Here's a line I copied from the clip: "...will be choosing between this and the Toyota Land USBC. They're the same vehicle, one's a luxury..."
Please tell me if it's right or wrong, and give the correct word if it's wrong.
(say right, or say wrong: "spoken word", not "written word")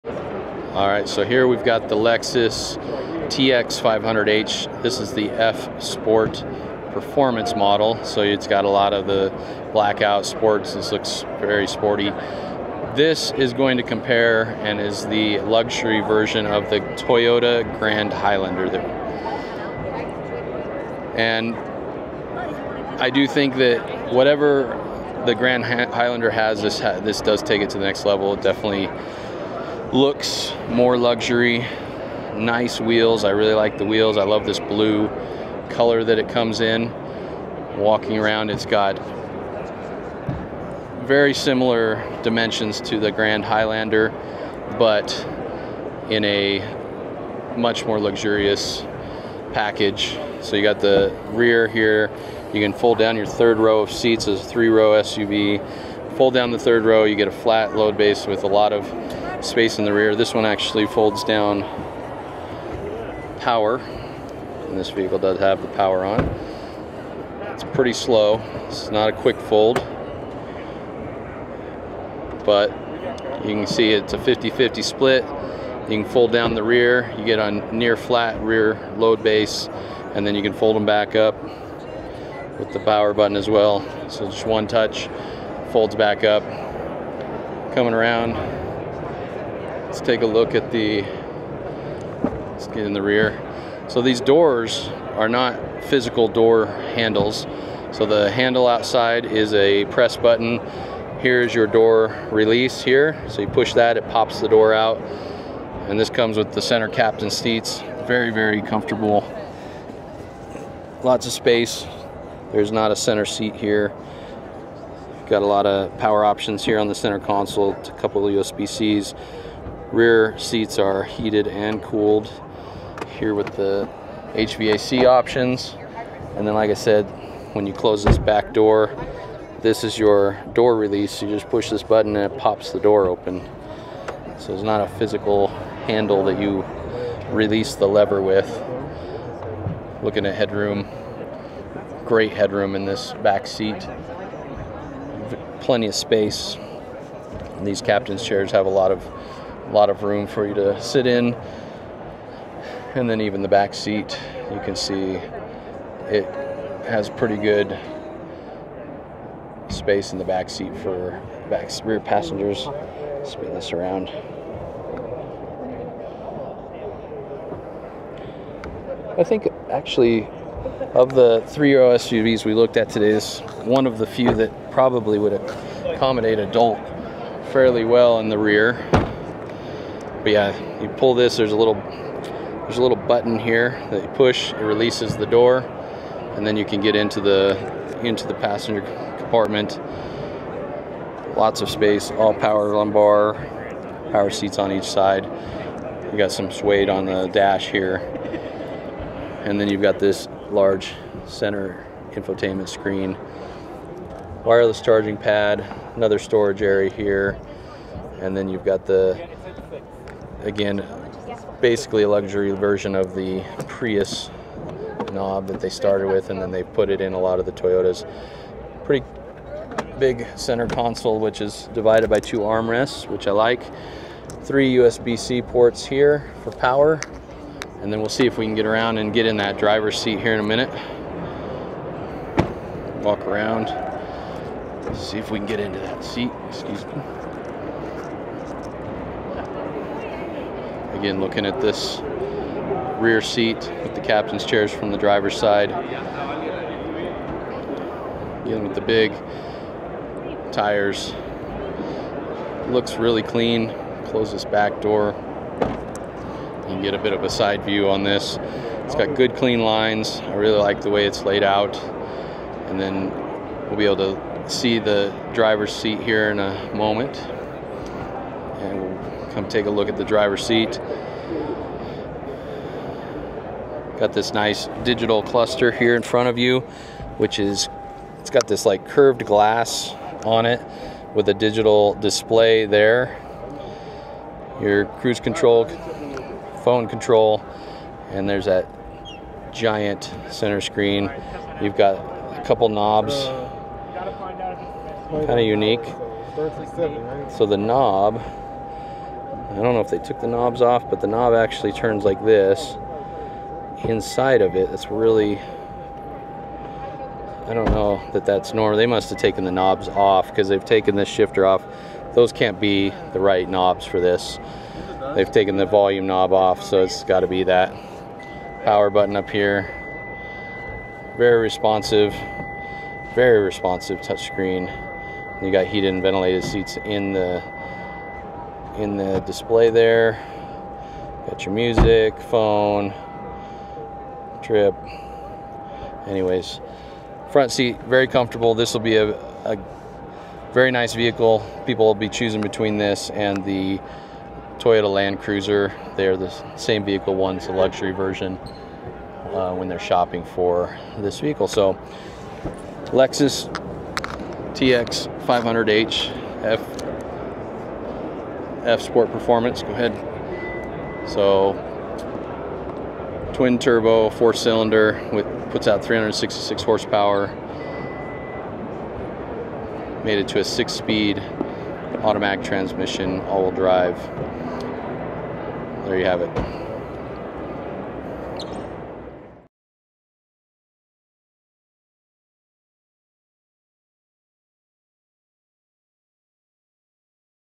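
wrong: "Cruiser", not "USBC".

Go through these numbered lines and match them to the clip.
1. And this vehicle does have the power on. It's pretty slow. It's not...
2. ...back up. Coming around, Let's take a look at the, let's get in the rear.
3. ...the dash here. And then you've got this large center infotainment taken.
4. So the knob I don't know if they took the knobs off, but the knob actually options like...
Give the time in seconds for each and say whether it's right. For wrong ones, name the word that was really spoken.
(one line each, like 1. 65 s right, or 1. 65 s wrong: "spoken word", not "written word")
1. 63 s right
2. 85 s right
3. 197 s wrong: "screen", not "taken"
4. 297 s wrong: "turns", not "options".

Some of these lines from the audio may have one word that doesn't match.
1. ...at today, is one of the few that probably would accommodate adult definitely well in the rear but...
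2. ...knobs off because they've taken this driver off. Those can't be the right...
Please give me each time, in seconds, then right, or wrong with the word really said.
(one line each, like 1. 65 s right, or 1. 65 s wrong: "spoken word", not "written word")
1. 172 s wrong: "fairly", not "definitely"
2. 309 s wrong: "shifter", not "driver".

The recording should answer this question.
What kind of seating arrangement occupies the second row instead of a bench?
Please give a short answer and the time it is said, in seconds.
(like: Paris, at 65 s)
Captain seats, at 106 s.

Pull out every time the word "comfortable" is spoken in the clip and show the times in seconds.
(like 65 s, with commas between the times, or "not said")
108 s, 338 s.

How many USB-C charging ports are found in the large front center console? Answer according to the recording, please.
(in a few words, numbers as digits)
3.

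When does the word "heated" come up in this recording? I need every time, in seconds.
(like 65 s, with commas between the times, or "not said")
121 s, 325 s.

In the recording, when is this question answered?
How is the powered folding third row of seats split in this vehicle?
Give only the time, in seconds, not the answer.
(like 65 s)
74 s.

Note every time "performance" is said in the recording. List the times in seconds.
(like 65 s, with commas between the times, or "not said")
6 s, 359 s.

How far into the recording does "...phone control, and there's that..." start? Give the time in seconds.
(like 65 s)
286 s.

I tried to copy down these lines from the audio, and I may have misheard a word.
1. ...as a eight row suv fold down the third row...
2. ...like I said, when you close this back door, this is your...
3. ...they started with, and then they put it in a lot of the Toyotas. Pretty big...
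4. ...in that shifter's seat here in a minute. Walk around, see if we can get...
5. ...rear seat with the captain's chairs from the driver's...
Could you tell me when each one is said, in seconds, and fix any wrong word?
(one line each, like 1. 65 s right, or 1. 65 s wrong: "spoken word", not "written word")
1. 54 s wrong: "three", not "eight"
2. 126 s right
3. 215 s right
4. 229 s wrong: "driver", not "shifter"
5. 243 s right.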